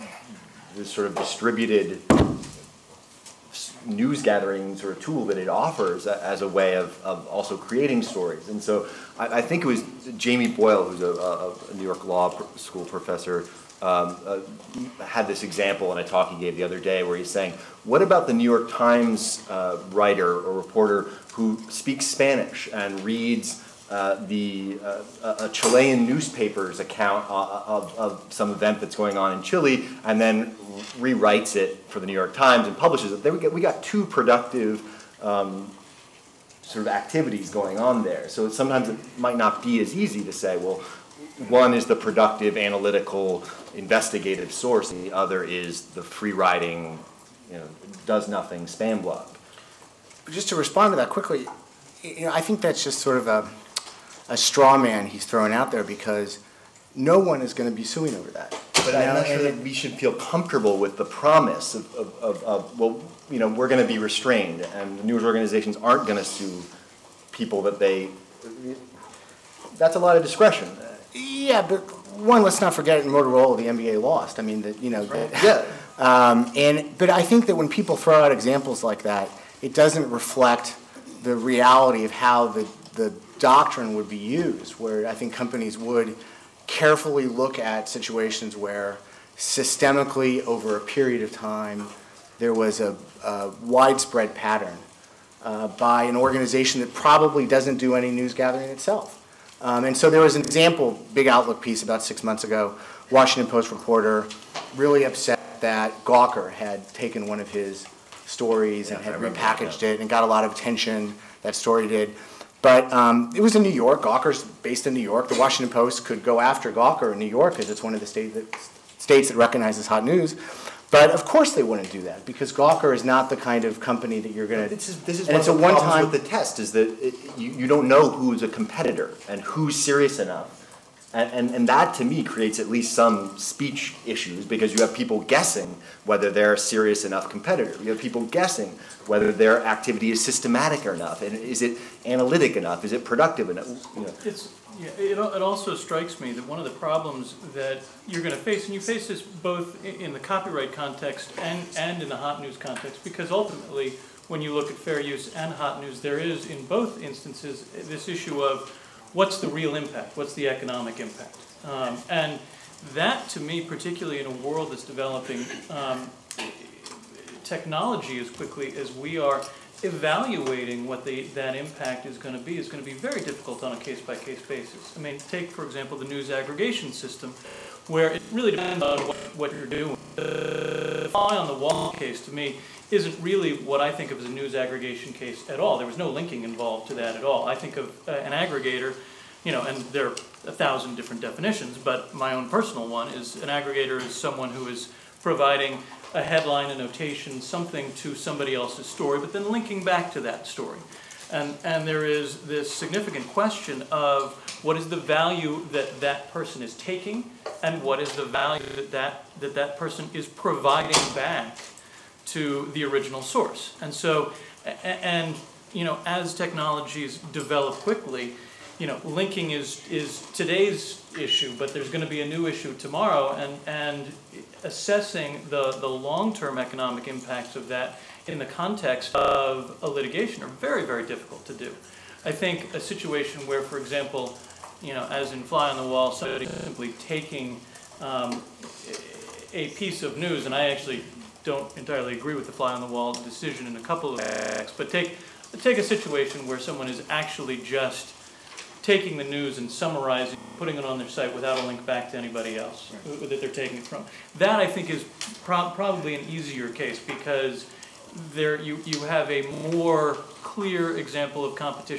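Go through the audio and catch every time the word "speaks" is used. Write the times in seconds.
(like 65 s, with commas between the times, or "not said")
21 s.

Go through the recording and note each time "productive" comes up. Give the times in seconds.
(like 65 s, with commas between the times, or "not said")
34 s, 41 s, 143 s.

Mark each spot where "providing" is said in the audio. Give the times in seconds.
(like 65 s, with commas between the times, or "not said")
195 s, 210 s.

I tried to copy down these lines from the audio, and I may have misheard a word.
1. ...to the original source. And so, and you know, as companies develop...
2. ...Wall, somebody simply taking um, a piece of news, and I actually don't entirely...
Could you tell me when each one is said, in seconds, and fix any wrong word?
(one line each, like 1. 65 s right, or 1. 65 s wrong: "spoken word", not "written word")
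1. 212 s wrong: "technologies", not "companies"
2. 235 s right.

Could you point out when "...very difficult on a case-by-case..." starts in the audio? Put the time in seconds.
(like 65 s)
172 s.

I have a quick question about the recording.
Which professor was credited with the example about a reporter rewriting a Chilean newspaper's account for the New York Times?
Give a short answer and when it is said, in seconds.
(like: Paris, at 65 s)
Jamie Boyle, at 10 s.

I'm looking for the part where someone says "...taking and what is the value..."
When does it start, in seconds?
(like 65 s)
206 s.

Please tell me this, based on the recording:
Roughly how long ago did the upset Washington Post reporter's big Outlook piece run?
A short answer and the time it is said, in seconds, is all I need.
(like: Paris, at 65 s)
about six months ago, at 101 s.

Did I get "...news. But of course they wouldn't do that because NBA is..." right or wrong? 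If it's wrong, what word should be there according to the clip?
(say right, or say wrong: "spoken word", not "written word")
wrong: "Gawker", not "NBA".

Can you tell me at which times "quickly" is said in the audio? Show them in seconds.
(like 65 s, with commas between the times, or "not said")
51 s, 168 s, 217 s.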